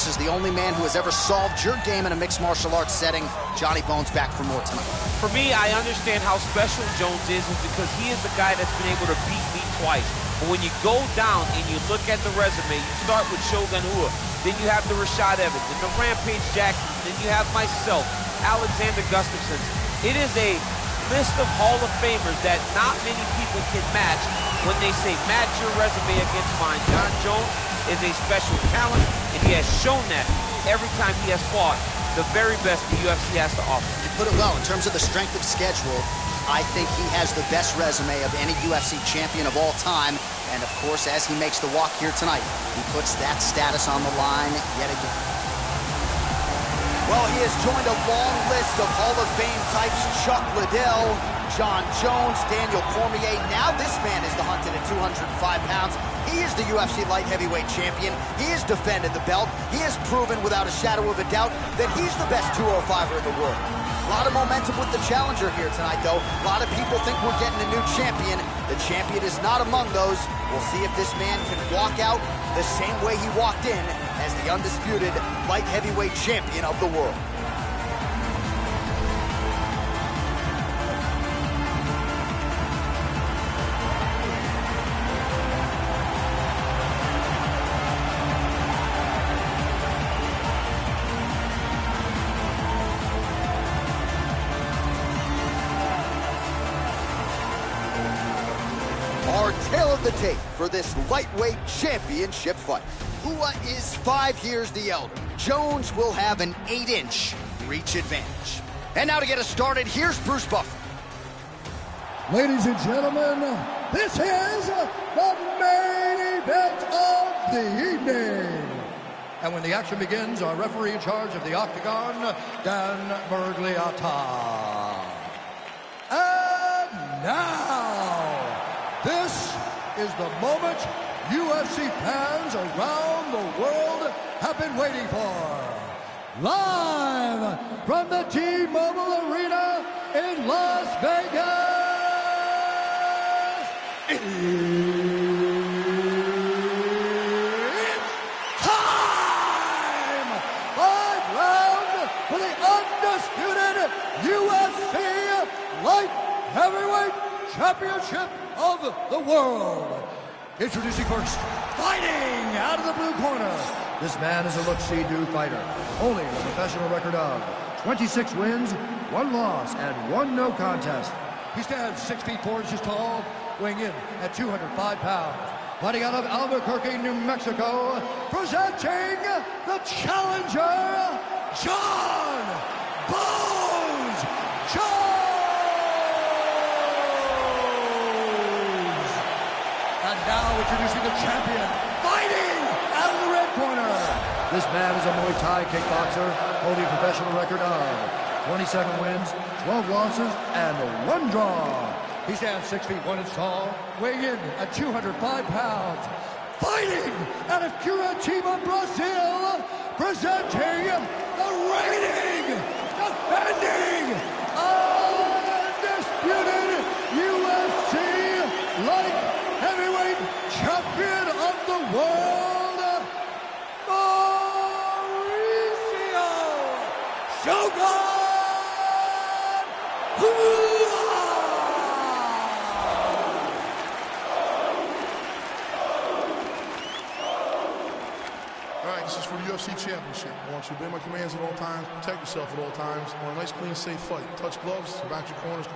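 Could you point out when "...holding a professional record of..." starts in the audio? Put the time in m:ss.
3:16.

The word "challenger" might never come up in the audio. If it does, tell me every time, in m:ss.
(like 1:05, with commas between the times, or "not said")
1:05, 2:59.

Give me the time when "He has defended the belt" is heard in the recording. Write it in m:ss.
0:58.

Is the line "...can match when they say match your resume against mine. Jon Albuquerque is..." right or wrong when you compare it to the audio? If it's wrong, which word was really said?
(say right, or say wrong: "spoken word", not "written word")
wrong: "Jones", not "Albuquerque".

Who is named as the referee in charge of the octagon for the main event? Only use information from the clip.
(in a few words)
Dan Miragliotta.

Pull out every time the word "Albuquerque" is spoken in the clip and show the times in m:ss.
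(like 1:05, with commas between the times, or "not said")
2:56.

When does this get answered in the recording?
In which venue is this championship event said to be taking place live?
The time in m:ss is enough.
2:18.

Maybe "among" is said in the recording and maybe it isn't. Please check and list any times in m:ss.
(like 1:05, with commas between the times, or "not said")
1:09.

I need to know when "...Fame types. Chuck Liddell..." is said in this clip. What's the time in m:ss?
0:49.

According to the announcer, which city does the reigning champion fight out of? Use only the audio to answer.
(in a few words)
Curitiba, Brazil.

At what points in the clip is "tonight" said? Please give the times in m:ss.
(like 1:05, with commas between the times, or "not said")
0:04, 0:42, 1:05.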